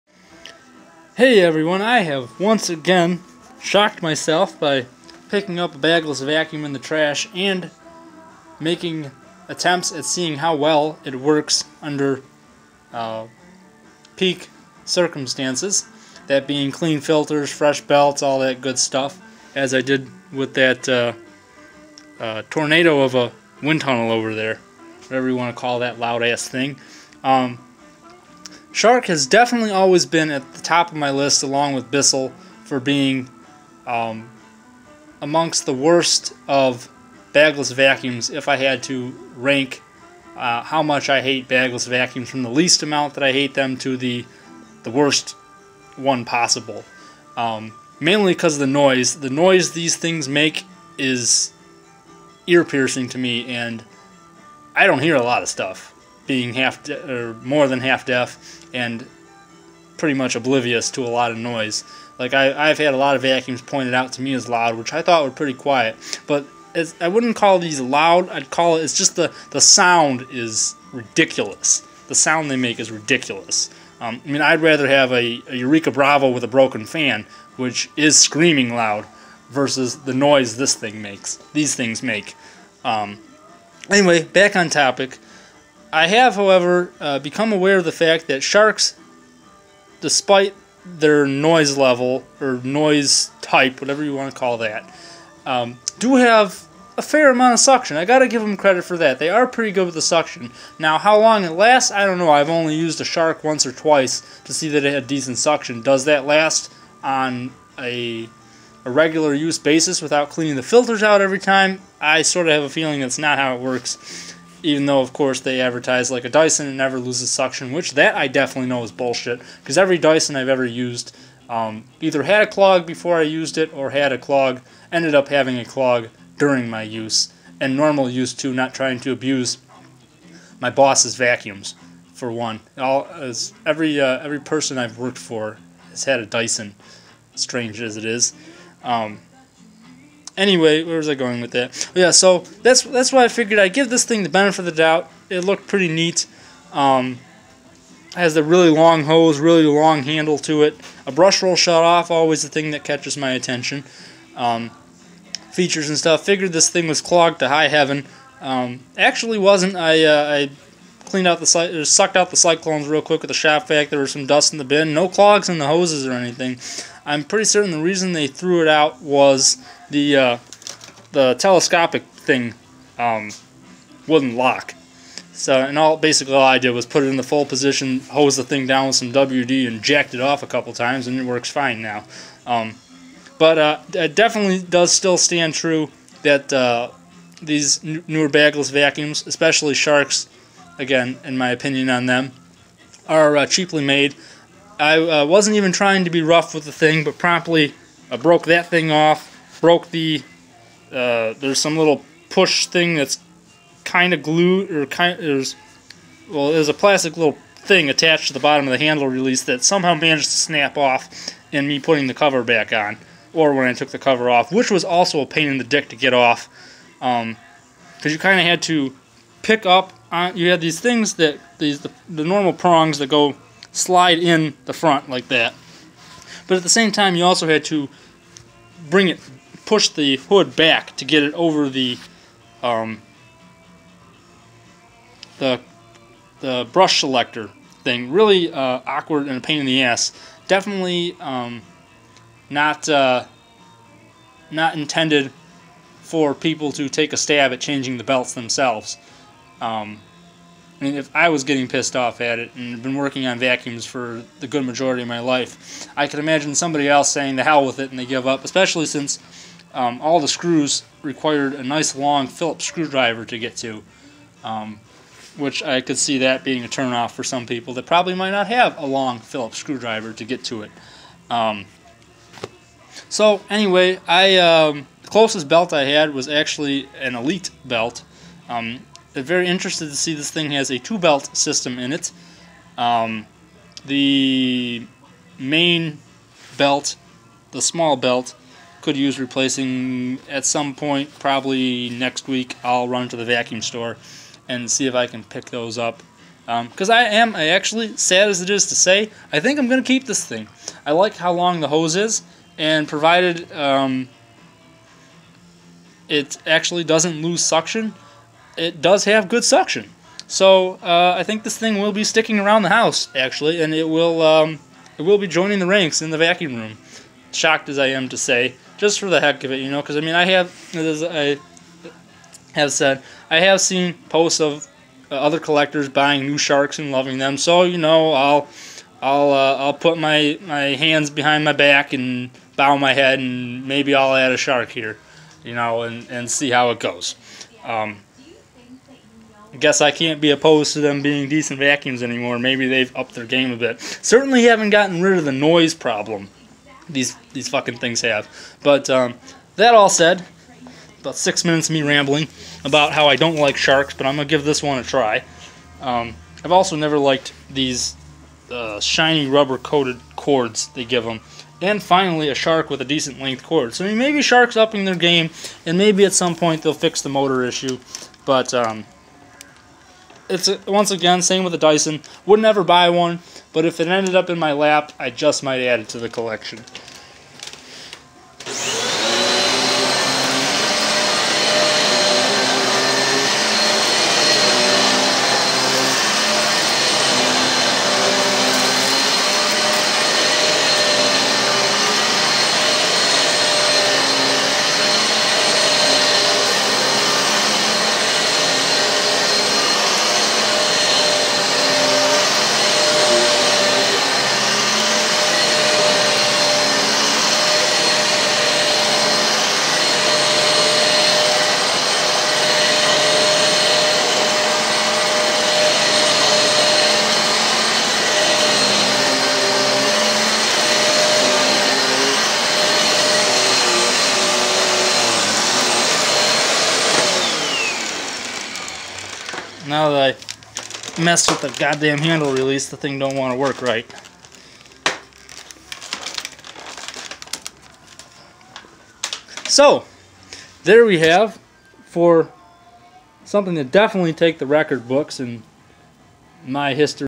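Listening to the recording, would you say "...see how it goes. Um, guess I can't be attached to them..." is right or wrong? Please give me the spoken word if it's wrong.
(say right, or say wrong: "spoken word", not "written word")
wrong: "opposed", not "attached".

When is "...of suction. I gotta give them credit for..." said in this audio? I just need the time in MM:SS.
01:37.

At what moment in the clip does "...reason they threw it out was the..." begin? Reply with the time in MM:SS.
02:47.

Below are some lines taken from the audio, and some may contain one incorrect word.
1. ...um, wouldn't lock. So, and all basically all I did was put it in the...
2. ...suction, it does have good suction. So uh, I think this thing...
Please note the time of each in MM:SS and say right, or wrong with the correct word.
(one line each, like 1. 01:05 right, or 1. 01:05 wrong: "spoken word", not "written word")
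1. 02:52 right
2. 05:07 right.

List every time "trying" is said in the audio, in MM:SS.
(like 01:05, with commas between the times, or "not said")
02:08, 03:15.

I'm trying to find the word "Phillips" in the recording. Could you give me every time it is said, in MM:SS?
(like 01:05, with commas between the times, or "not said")
04:22, 04:29.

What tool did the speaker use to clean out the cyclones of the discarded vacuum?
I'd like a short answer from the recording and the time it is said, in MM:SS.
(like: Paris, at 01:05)
Shop-Vac, at 02:43.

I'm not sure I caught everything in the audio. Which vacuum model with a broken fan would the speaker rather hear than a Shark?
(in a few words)
Eureka Bravo.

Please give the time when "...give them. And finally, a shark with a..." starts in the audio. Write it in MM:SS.
06:00.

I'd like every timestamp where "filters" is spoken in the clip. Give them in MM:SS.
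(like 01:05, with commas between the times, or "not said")
00:17, 01:50.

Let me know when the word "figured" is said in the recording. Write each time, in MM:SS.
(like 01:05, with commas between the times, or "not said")
02:23, 02:36.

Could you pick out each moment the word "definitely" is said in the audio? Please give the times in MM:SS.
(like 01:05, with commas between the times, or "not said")
00:29, 01:58, 03:04, 04:00, 07:23.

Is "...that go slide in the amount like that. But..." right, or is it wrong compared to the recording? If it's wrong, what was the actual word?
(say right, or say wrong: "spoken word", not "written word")
wrong: "front", not "amount".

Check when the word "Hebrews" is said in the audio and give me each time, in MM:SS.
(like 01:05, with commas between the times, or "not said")
not said.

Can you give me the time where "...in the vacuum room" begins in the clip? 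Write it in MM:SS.
05:16.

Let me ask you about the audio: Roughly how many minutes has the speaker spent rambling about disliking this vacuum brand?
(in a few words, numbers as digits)
6.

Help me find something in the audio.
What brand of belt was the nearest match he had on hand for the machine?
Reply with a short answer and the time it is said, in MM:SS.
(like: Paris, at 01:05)
Elite, at 04:37.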